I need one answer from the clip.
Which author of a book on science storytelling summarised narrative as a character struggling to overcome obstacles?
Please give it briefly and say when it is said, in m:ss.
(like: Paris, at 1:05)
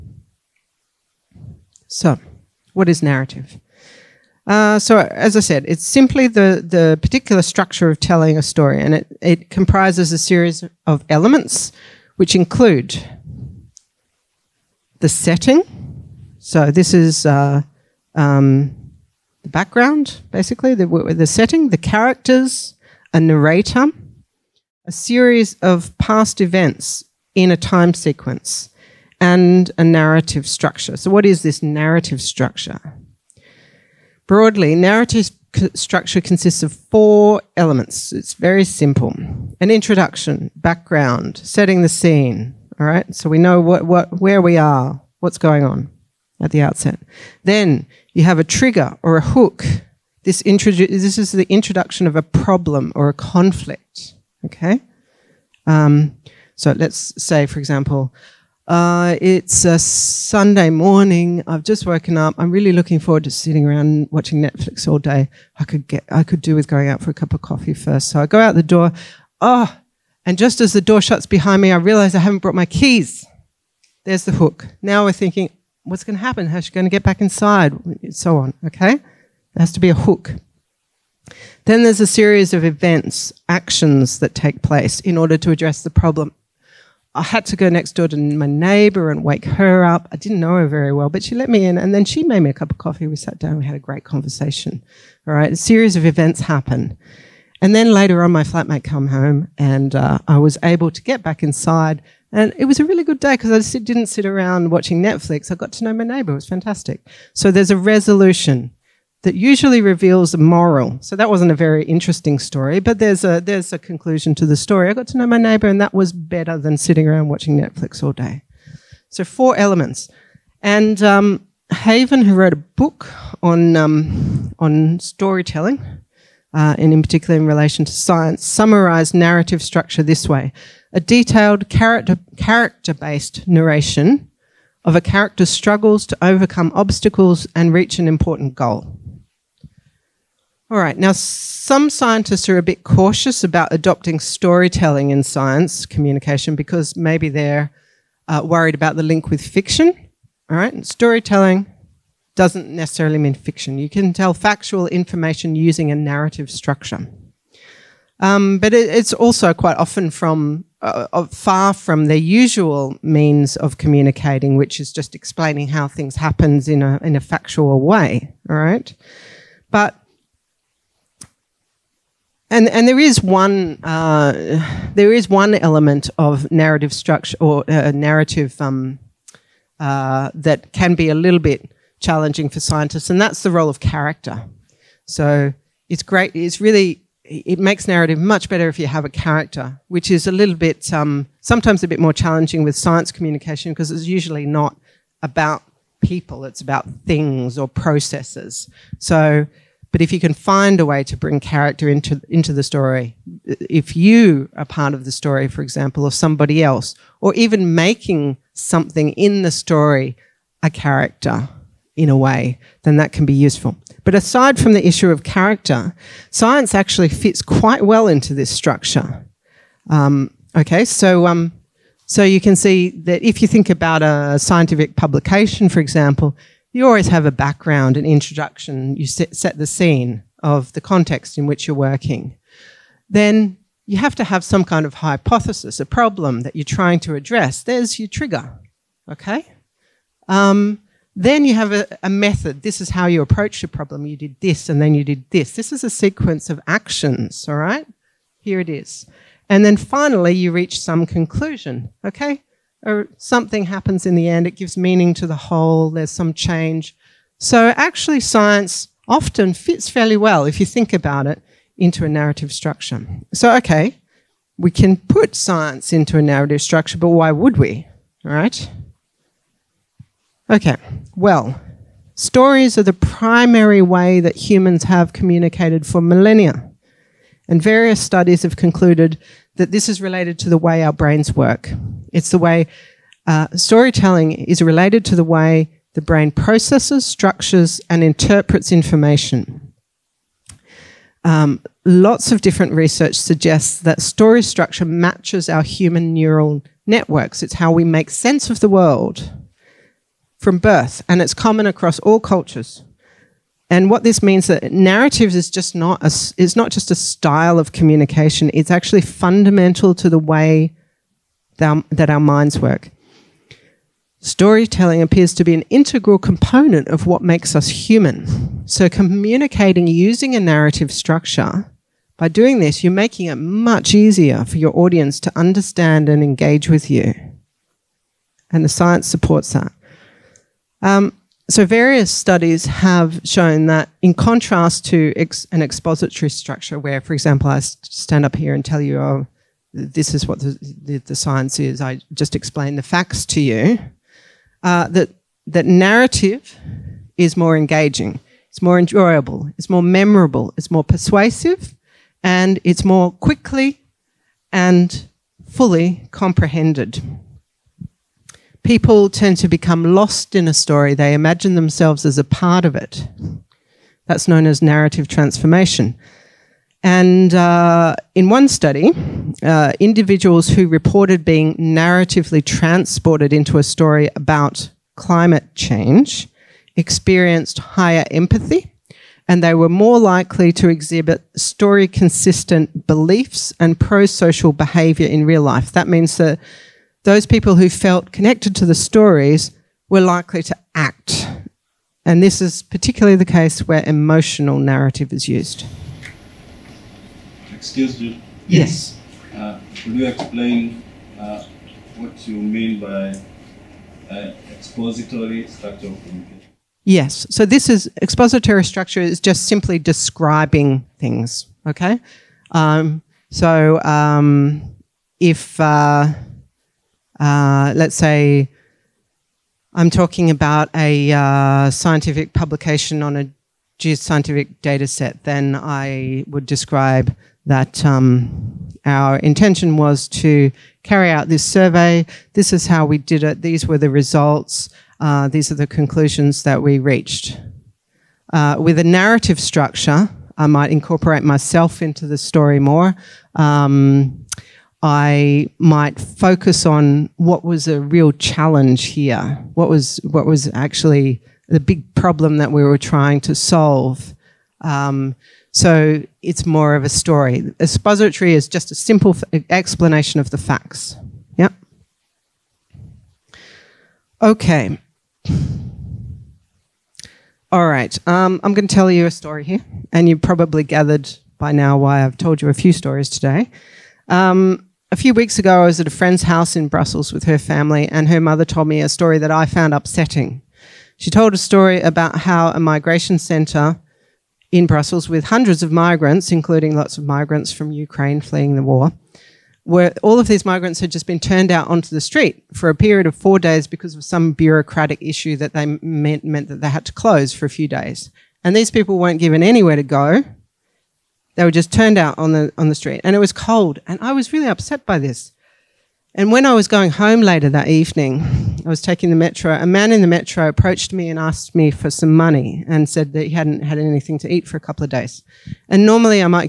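Haven, at 2:01.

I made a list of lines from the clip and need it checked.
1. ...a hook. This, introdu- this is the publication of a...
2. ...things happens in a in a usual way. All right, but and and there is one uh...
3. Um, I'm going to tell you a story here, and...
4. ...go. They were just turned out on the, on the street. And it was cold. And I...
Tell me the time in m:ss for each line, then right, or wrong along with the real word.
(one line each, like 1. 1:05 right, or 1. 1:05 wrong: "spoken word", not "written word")
1. 0:49 wrong: "introduction", not "publication"
2. 2:45 wrong: "factual", not "usual"
3. 7:48 right
4. 8:19 right.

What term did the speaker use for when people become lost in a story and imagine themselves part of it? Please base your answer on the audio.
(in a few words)
narrative transformation.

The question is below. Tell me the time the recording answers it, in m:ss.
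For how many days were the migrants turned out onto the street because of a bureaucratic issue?
8:13.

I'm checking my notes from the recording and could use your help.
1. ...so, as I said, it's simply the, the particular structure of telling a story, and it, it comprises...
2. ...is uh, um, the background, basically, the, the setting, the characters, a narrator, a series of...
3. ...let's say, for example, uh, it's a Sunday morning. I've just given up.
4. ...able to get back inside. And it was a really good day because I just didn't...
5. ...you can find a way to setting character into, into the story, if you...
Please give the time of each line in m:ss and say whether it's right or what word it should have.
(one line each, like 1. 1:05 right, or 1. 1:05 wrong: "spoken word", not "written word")
1. 0:04 right
2. 0:16 right
3. 0:56 wrong: "woken", not "given"
4. 1:40 right
5. 3:20 wrong: "bring", not "setting".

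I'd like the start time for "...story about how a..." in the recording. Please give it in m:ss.
8:01.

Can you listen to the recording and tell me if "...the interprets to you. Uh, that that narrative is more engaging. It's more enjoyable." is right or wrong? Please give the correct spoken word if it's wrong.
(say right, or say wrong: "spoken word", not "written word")
wrong: "facts", not "interprets".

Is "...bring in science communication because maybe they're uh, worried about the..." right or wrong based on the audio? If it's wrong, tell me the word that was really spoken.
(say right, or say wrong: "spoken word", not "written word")
wrong: "storytelling", not "bring".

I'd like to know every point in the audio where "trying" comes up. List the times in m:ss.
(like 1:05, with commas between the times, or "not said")
3:56, 7:32.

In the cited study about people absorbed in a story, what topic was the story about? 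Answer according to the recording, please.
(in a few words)
climate change.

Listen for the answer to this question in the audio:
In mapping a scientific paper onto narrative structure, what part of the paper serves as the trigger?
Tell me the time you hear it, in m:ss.
3:54.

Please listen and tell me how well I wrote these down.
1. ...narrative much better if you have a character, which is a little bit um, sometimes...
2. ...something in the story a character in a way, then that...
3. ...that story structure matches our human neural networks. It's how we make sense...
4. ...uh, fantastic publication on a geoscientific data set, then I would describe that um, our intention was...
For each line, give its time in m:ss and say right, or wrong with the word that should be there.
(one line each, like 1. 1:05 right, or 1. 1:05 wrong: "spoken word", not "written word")
1. 3:07 right
2. 3:28 right
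3. 4:53 right
4. 7:01 wrong: "scientific", not "fantastic".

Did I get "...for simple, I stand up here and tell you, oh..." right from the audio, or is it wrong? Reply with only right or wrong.
wrong.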